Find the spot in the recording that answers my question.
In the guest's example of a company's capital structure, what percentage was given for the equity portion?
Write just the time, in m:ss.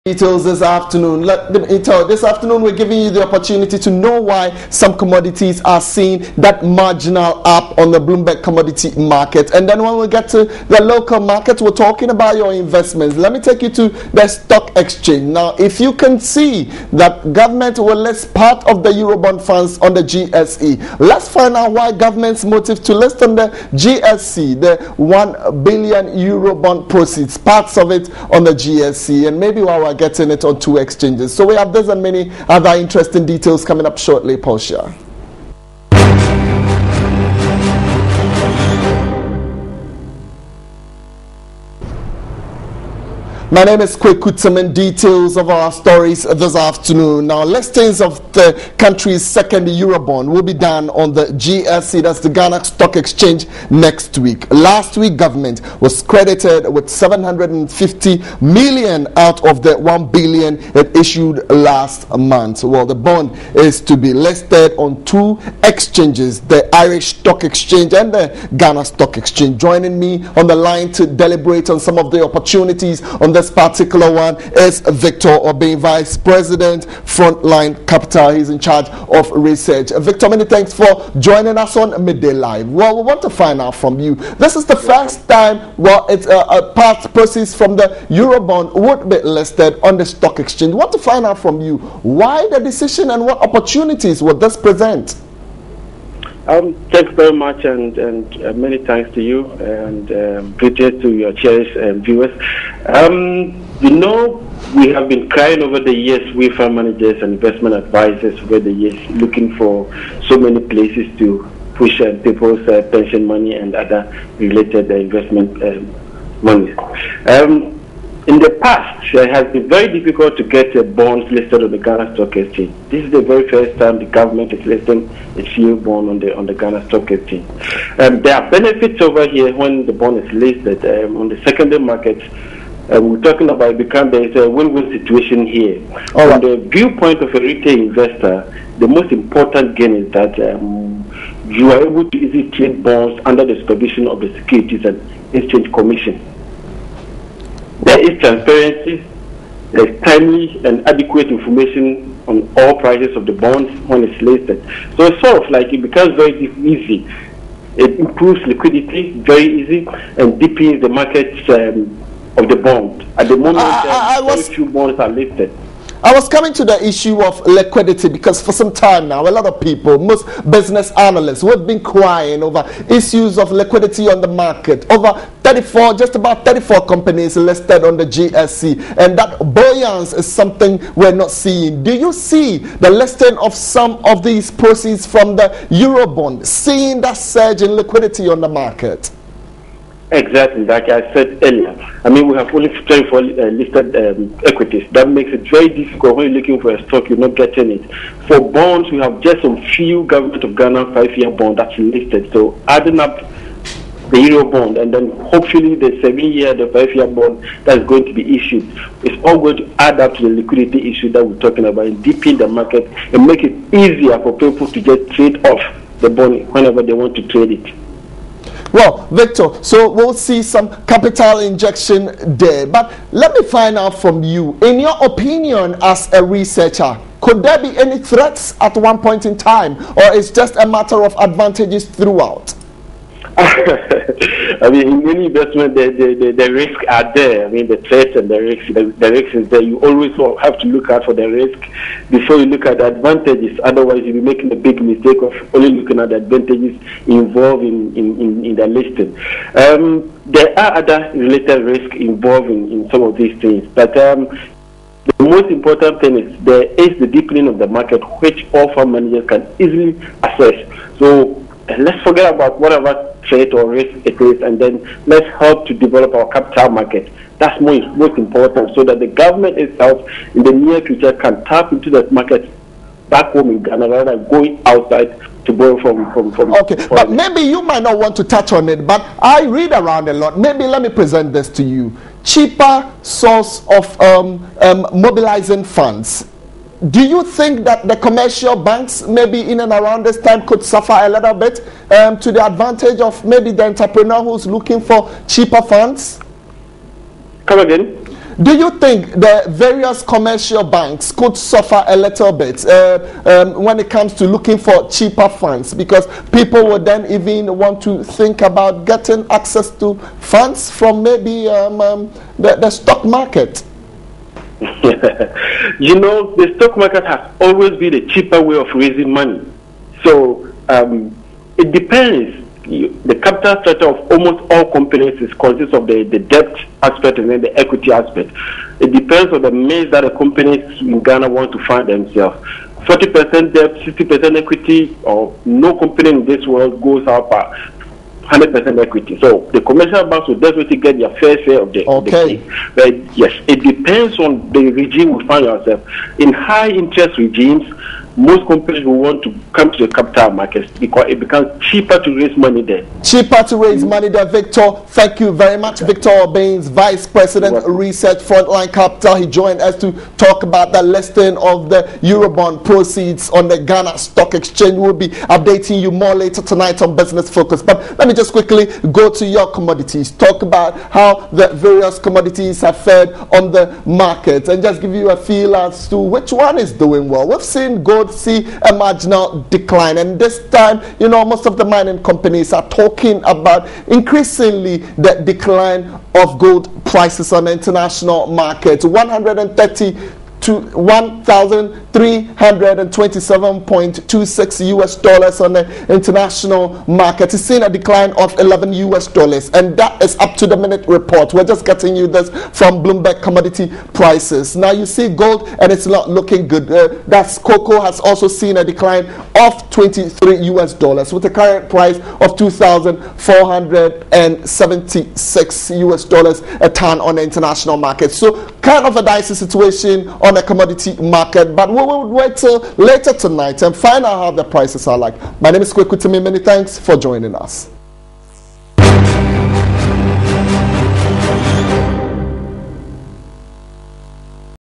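5:33.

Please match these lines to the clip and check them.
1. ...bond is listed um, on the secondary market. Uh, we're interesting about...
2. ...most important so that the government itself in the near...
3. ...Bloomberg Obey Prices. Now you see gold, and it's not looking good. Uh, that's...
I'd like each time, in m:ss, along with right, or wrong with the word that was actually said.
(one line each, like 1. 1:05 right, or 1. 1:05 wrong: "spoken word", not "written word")
1. 2:09 wrong: "talking", not "interesting"
2. 4:27 right
3. 6:42 wrong: "Commodity", not "Obey".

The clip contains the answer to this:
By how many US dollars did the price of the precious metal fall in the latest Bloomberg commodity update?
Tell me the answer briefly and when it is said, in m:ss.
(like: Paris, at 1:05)
11 US dollars, at 6:38.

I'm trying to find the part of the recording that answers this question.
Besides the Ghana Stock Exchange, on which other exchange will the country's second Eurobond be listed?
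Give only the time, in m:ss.
1:06.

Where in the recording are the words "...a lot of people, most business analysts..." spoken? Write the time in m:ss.
2:49.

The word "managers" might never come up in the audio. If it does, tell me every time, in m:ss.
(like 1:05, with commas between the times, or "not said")
1:46, 4:18.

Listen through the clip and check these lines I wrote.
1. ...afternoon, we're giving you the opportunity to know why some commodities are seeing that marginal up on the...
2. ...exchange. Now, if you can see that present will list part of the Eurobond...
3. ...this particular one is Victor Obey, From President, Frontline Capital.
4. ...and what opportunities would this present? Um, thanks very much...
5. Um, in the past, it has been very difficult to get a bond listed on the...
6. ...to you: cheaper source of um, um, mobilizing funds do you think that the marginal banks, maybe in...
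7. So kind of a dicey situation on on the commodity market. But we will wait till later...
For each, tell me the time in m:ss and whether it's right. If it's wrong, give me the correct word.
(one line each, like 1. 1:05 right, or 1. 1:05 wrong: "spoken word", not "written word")
1. 0:02 right
2. 0:14 wrong: "government", not "present"
3. 1:13 wrong: "Vice", not "From"
4. 1:33 right
5. 1:57 right
6. 4:41 wrong: "commercial", not "marginal"
7. 6:58 right.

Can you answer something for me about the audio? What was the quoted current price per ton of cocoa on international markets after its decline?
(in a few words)
2,476 US dollars.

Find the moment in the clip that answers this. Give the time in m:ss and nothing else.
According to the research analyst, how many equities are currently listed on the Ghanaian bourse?
3:12.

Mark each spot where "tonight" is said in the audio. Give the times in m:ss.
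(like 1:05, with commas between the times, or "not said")
6:06, 7:03.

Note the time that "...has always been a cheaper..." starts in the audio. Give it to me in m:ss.
5:17.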